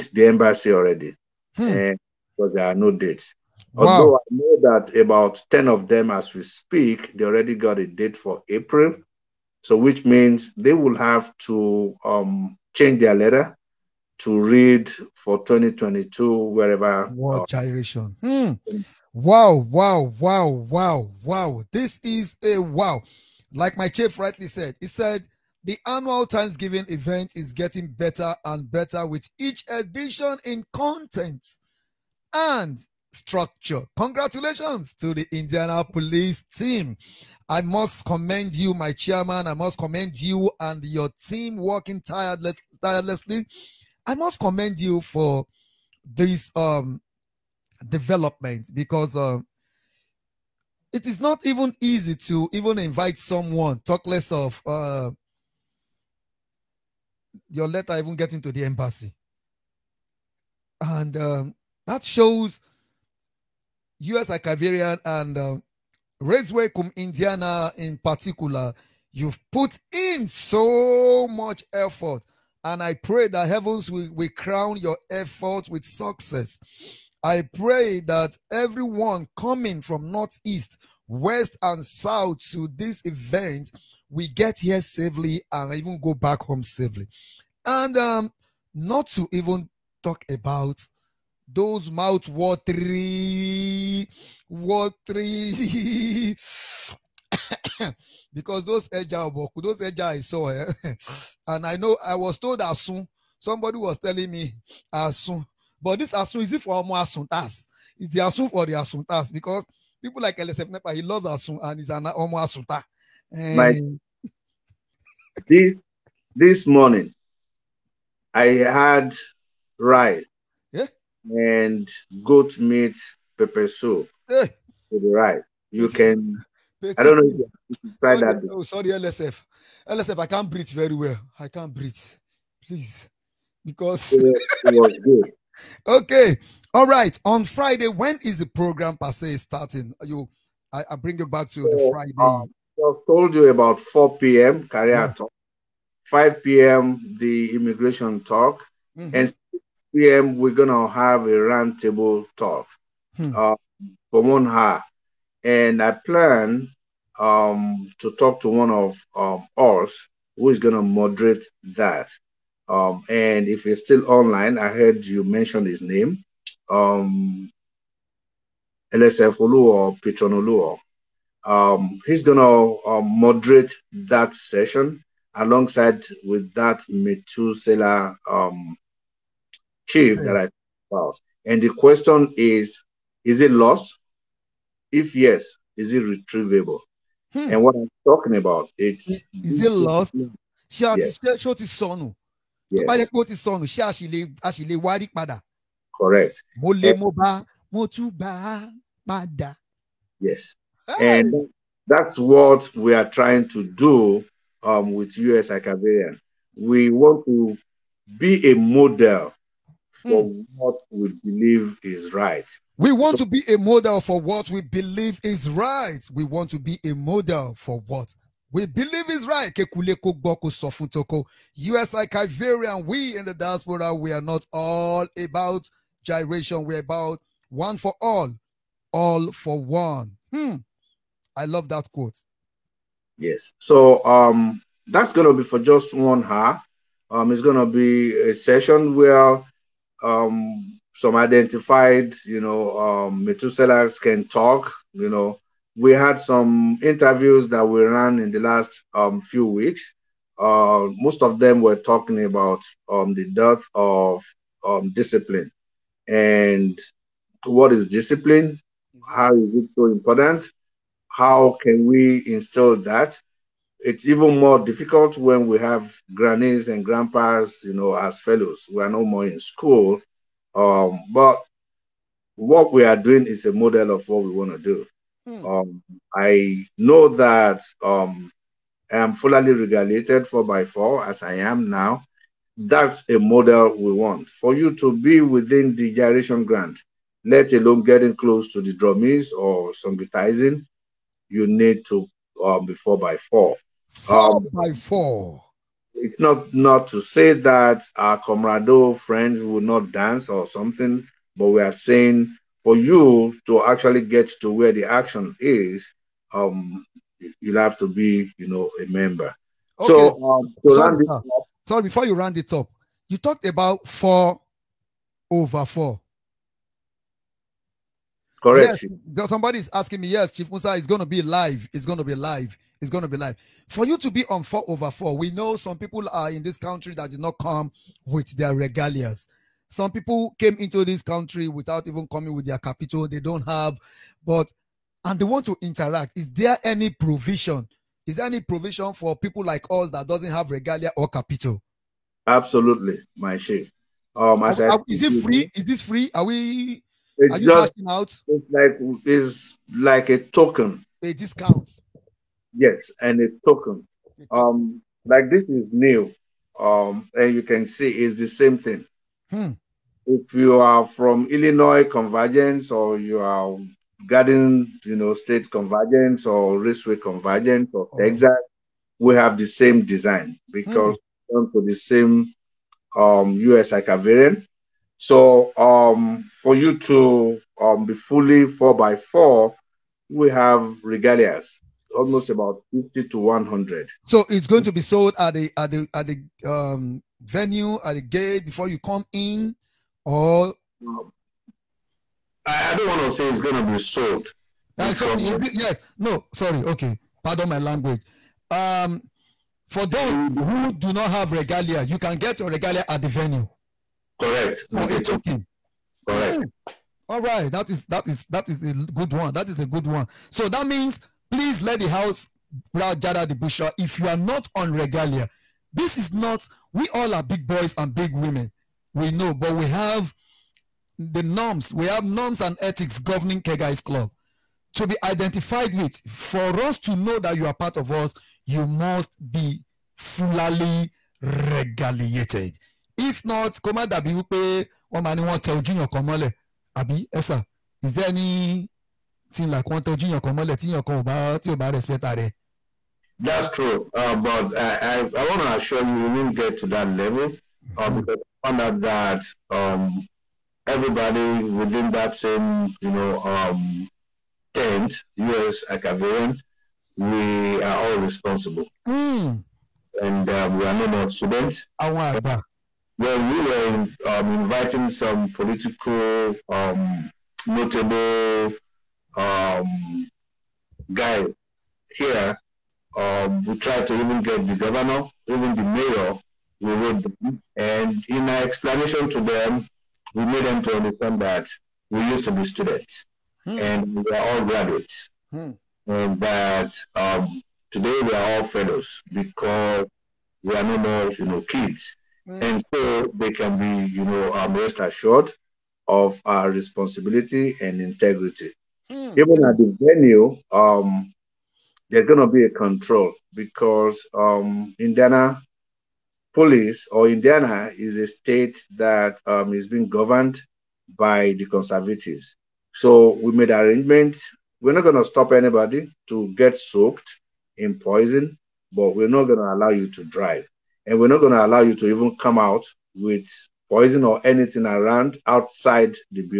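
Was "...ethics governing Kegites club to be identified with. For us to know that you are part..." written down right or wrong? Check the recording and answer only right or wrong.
right.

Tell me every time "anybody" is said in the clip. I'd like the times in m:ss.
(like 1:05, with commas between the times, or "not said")
8:35.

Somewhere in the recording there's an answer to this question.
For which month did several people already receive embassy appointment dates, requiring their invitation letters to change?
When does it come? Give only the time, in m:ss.
0:08.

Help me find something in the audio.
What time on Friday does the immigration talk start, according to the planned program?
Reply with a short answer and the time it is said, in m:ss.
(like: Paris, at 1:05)
5 p.m., at 2:26.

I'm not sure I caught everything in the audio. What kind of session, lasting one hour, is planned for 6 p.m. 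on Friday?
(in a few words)
roundtable talk.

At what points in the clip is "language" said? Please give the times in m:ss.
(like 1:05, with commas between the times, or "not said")
6:37.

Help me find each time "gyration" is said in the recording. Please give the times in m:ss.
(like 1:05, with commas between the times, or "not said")
0:17, 3:46.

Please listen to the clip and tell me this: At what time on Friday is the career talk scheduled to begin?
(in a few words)
4 p.m.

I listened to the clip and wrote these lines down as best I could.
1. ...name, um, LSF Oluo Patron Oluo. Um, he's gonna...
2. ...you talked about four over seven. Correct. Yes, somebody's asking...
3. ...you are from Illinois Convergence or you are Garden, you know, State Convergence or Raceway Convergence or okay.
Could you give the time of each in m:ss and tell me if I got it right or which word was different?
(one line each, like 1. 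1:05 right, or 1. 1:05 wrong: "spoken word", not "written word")
1. 2:45 right
2. 5:13 wrong: "four", not "seven"
3. 6:00 right.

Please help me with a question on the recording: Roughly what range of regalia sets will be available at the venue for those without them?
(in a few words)
50 to 100.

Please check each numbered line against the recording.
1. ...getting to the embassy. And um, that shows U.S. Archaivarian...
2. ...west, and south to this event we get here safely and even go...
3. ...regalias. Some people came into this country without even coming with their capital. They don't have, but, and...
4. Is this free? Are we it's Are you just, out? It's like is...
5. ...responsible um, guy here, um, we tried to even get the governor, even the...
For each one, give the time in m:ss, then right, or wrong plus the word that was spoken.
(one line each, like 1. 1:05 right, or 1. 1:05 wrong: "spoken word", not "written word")
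1. 0:58 right
2. 1:21 right
3. 5:28 right
4. 5:45 right
5. 7:47 wrong: "notable", not "responsible".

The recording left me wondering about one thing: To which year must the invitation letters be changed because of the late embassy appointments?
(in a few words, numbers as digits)
2022.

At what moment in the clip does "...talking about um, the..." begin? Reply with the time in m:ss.
4:11.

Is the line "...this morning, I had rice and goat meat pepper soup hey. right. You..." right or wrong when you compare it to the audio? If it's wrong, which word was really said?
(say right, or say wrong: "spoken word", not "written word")
right.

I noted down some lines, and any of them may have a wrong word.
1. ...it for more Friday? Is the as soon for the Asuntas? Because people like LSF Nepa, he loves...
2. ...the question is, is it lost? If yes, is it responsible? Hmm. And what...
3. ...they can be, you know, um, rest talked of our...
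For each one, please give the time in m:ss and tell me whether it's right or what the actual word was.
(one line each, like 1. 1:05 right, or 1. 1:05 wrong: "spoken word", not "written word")
1. 1:46 wrong: "Asuntas", not "Friday"
2. 3:01 wrong: "retrievable", not "responsible"
3. 8:13 wrong: "assured", not "talked".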